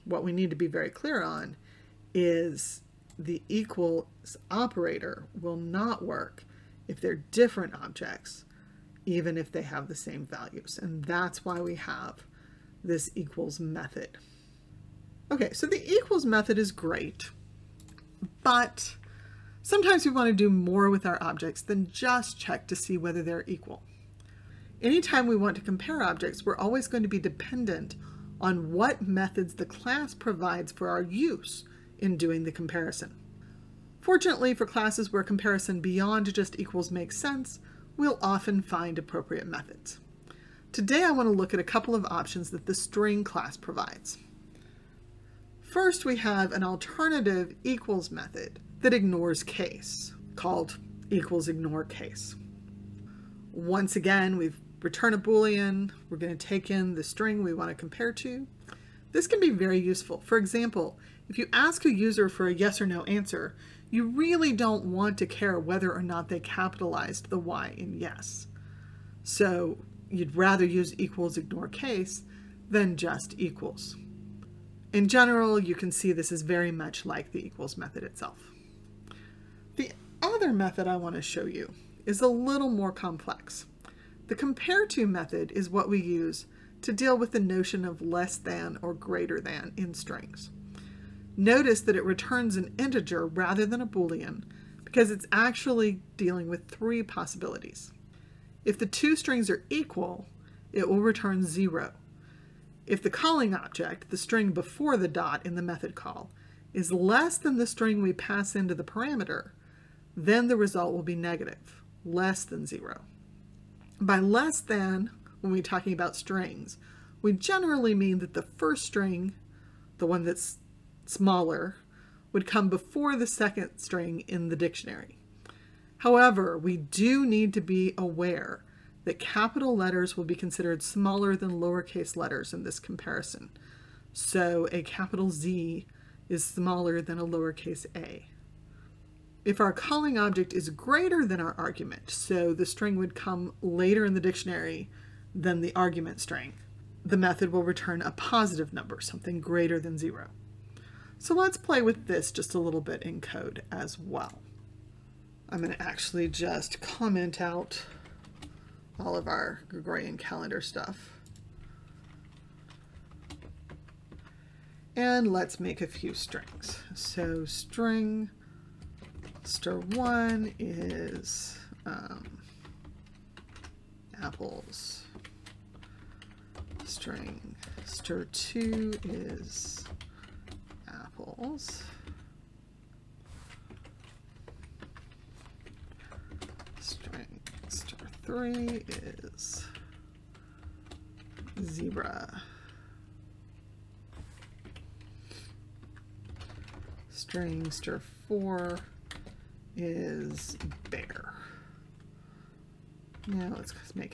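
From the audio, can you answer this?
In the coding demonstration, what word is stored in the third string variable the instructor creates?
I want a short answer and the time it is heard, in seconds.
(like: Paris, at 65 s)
zebra, at 191 s.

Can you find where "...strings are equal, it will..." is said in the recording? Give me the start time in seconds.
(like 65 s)
99 s.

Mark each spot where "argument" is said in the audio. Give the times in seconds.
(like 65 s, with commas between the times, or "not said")
141 s, 145 s.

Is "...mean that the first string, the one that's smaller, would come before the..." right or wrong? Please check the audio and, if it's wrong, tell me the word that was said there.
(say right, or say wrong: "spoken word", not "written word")
right.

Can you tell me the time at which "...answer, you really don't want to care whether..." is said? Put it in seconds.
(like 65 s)
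63 s.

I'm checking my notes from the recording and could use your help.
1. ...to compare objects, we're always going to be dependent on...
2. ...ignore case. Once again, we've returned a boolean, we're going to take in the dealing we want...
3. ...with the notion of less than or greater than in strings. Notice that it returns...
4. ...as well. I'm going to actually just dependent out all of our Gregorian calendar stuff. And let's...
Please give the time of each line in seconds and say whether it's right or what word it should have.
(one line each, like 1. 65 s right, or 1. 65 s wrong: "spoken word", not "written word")
1. 25 s right
2. 51 s wrong: "string", not "dealing"
3. 87 s right
4. 153 s wrong: "comment", not "dependent".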